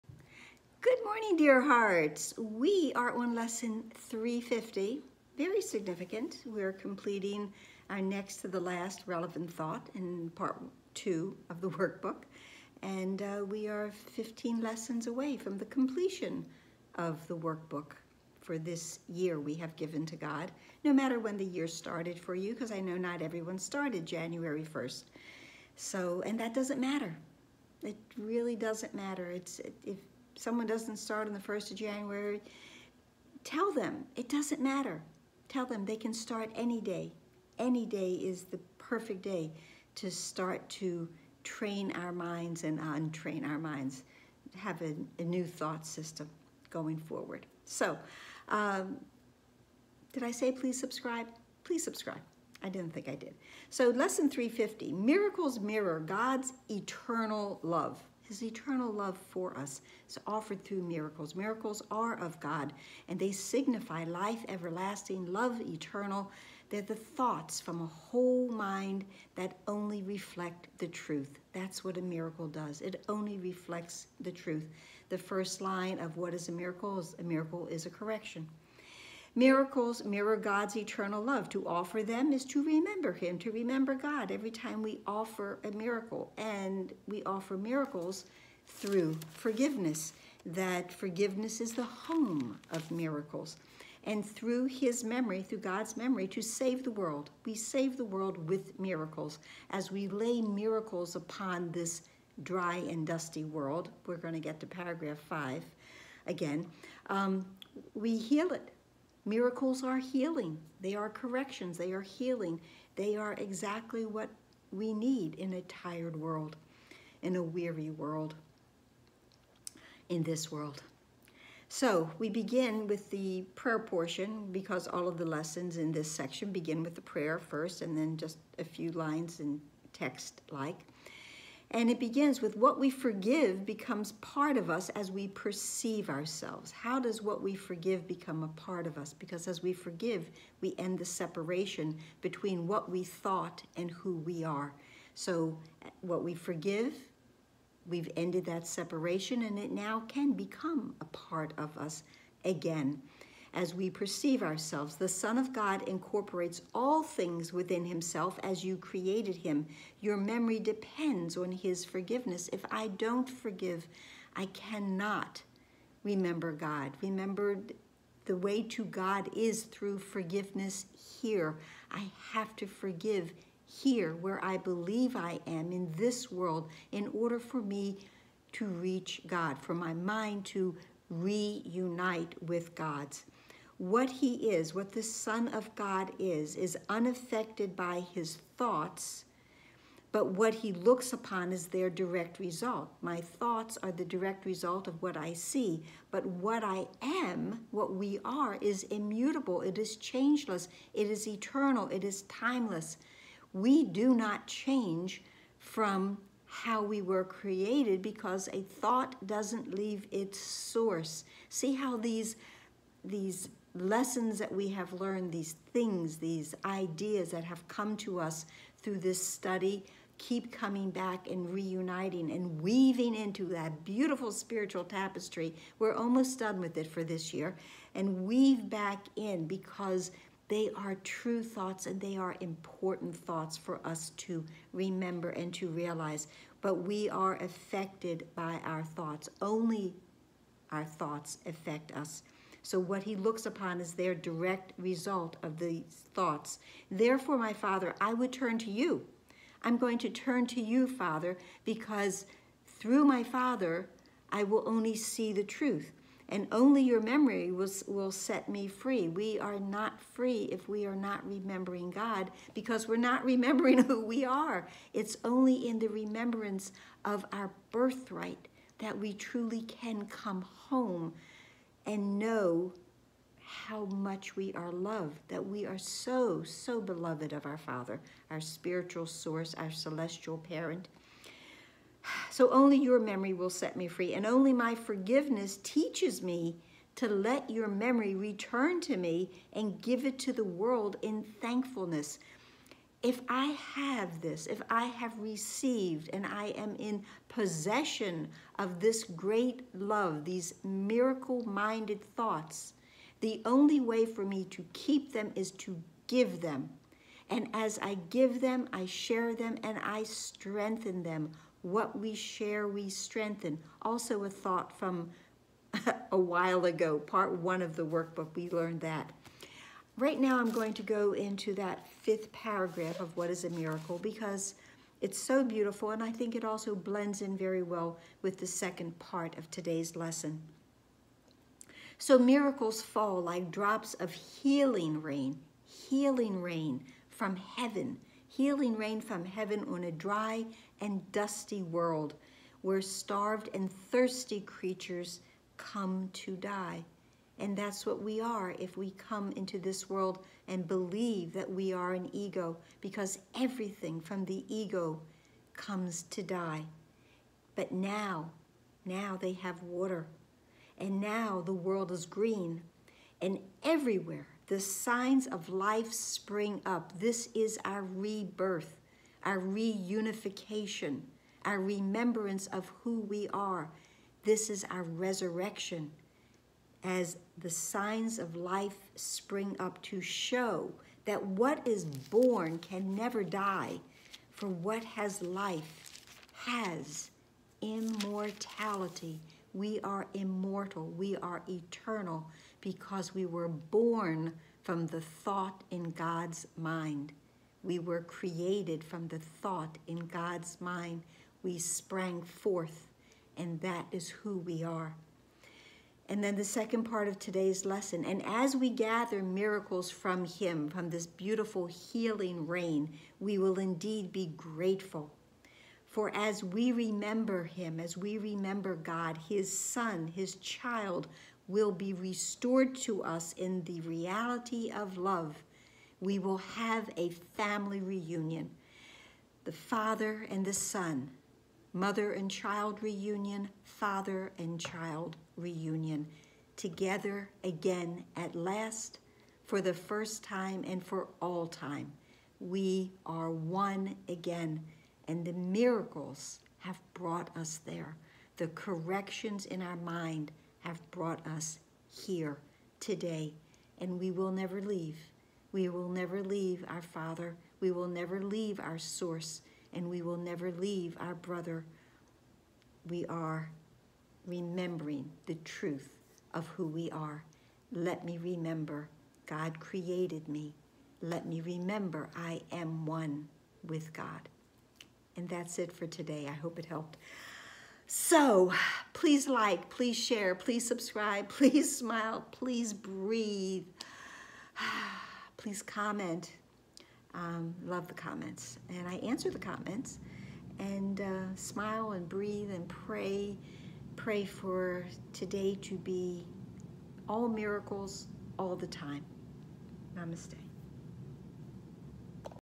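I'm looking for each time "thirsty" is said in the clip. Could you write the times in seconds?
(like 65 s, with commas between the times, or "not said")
343 s.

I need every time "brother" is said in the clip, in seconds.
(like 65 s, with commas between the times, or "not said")
461 s.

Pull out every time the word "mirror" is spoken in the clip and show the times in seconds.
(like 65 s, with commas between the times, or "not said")
55 s, 80 s.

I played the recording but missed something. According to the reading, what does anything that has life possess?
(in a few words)
Immortality.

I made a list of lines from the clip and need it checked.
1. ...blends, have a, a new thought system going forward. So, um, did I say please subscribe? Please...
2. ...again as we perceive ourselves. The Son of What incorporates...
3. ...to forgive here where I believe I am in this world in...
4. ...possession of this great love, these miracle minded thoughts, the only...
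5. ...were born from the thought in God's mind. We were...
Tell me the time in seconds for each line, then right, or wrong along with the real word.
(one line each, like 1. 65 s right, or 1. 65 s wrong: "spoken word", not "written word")
1. 43 s wrong: "minds", not "blends"
2. 152 s wrong: "God", not "What"
3. 172 s right
4. 297 s right
5. 393 s right.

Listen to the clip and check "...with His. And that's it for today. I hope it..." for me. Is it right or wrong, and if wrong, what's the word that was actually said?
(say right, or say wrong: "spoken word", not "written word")
wrong: "God", not "His".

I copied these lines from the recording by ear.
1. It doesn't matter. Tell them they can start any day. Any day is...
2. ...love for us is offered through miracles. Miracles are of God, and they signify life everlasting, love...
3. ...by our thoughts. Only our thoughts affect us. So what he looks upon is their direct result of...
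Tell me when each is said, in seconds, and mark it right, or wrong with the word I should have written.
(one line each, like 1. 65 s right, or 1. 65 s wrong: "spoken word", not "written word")
1. 34 s right
2. 58 s right
3. 238 s right.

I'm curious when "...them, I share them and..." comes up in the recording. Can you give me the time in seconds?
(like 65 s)
308 s.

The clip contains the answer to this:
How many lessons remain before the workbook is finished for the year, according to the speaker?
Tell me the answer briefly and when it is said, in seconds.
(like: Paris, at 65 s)
15, at 13 s.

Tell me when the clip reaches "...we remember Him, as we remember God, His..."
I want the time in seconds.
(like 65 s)
416 s.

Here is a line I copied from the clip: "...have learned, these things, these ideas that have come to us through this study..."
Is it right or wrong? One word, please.
right.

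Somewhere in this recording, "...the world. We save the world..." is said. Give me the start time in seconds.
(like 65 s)
96 s.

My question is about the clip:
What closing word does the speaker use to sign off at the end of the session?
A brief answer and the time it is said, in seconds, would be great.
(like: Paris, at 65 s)
Namaste, at 499 s.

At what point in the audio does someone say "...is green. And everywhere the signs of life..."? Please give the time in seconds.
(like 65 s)
361 s.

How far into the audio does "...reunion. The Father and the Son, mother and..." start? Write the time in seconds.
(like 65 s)
427 s.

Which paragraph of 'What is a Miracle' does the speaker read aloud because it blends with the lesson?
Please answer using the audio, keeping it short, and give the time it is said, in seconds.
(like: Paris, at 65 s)
Fifth paragraph, at 321 s.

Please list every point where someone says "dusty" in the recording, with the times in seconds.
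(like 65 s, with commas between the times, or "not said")
103 s, 341 s.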